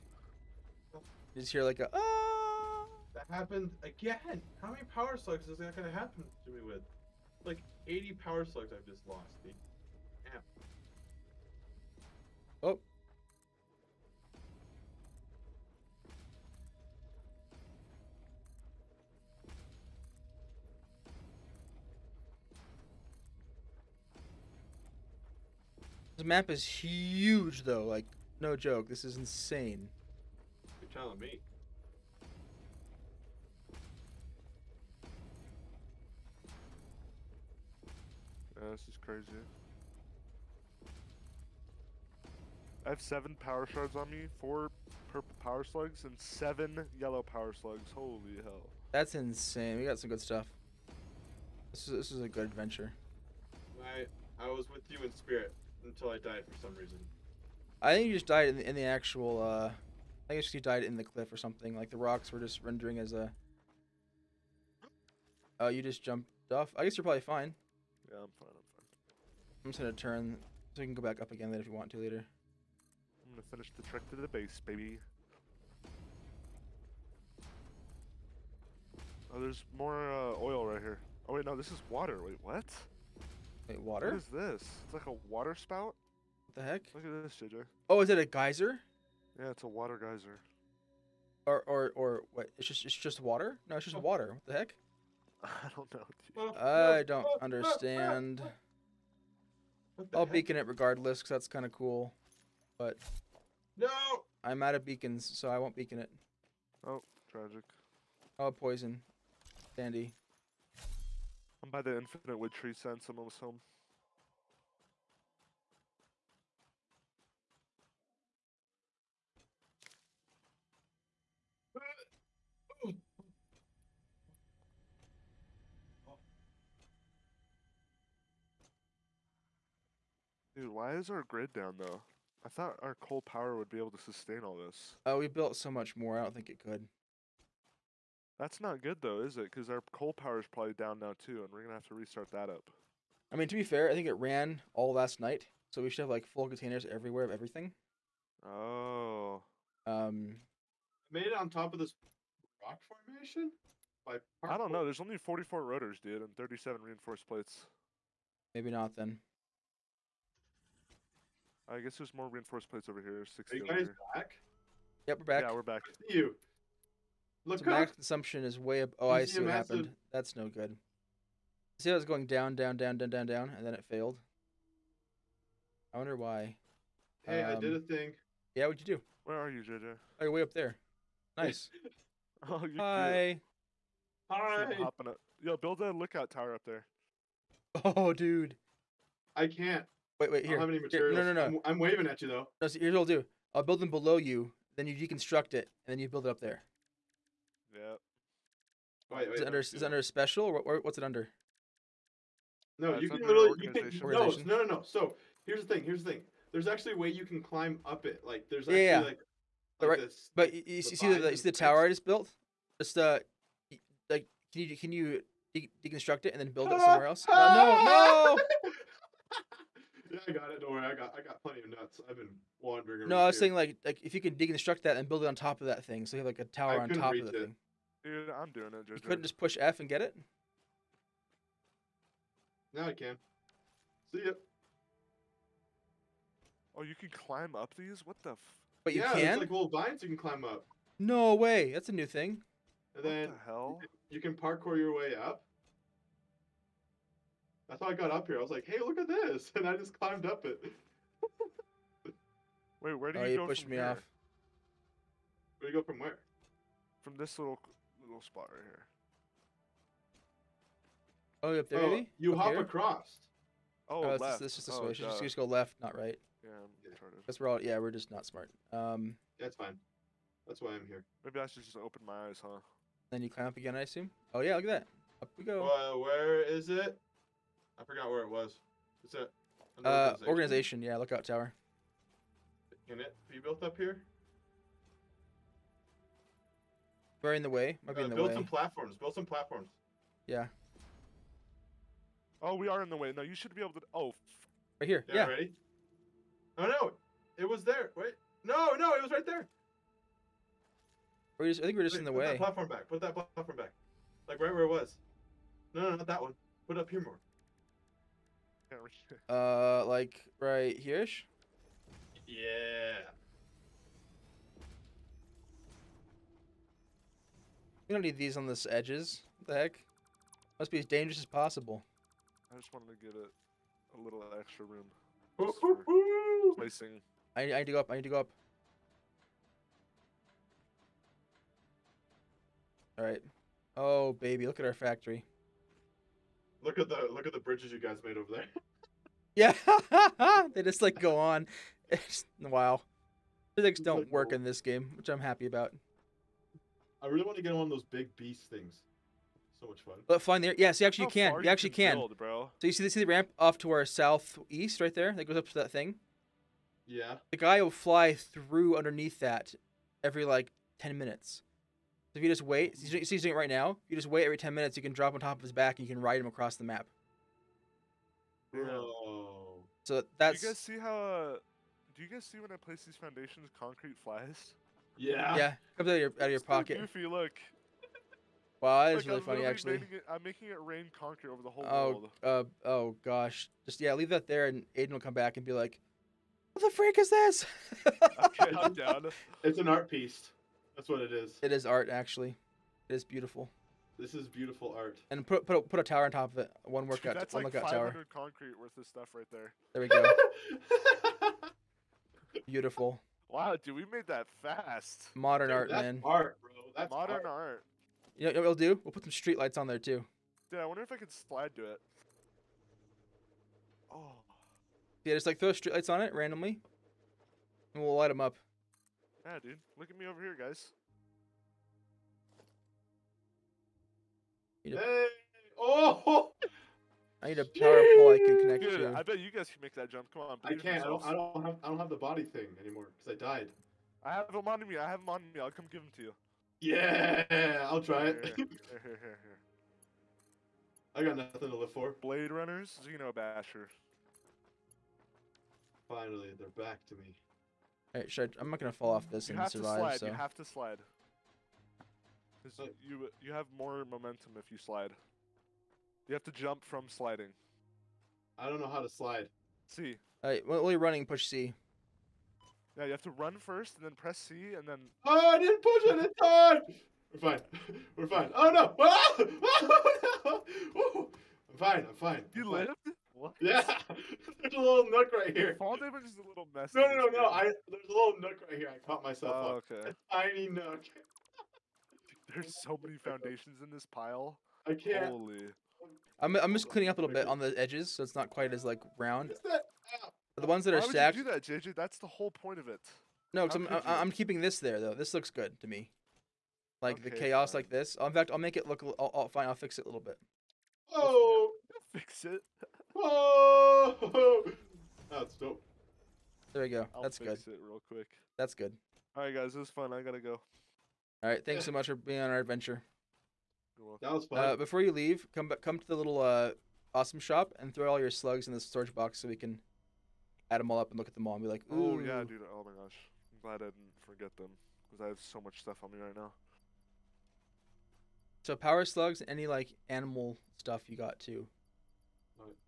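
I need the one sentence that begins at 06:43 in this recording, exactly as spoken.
Wow, dude, we made that fast.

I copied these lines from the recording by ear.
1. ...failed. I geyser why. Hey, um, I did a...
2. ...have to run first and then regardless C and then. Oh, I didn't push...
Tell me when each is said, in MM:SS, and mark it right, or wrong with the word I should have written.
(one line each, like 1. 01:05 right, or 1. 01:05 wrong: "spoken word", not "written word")
1. 02:53 wrong: "wonder", not "geyser"
2. 07:42 wrong: "press", not "regardless".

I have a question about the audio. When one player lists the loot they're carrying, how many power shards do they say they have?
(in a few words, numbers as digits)
7.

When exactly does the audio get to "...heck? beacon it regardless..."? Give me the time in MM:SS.
01:40.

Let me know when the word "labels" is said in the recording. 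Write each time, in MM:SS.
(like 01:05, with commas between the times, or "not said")
not said.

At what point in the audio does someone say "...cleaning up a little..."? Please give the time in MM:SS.
08:06.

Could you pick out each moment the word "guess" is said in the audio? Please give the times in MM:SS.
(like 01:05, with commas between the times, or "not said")
01:00, 01:06, 02:41.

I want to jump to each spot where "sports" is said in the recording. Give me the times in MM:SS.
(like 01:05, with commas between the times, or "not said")
not said.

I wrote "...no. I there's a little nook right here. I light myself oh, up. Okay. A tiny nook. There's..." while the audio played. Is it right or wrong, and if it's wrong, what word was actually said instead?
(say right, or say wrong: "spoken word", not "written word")
wrong: "caught", not "light".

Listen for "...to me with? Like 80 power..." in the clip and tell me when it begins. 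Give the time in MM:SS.
00:06.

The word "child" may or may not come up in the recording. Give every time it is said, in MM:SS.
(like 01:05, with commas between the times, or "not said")
not said.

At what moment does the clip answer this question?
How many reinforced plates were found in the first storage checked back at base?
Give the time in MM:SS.
02:36.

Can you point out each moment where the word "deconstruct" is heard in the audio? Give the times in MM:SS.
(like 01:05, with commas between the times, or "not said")
03:14, 03:35, 03:44.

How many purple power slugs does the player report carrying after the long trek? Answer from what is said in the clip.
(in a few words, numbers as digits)
4.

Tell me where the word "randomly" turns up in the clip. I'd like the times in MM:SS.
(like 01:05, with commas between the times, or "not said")
06:56.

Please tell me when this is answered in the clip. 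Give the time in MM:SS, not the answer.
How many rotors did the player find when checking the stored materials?
02:35.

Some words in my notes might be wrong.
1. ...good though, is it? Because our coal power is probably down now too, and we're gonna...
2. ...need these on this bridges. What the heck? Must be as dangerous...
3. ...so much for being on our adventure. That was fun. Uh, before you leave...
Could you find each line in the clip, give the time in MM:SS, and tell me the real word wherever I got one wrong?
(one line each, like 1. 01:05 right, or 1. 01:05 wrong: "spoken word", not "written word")
1. 02:18 right
2. 05:18 wrong: "edges", not "bridges"
3. 08:31 right.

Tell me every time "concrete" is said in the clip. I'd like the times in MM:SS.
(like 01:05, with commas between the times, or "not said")
06:13, 06:20, 06:38.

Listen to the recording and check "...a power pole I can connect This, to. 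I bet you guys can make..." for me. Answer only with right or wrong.
wrong.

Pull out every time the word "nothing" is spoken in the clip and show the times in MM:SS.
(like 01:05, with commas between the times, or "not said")
07:21.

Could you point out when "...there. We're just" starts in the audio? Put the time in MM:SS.
04:59.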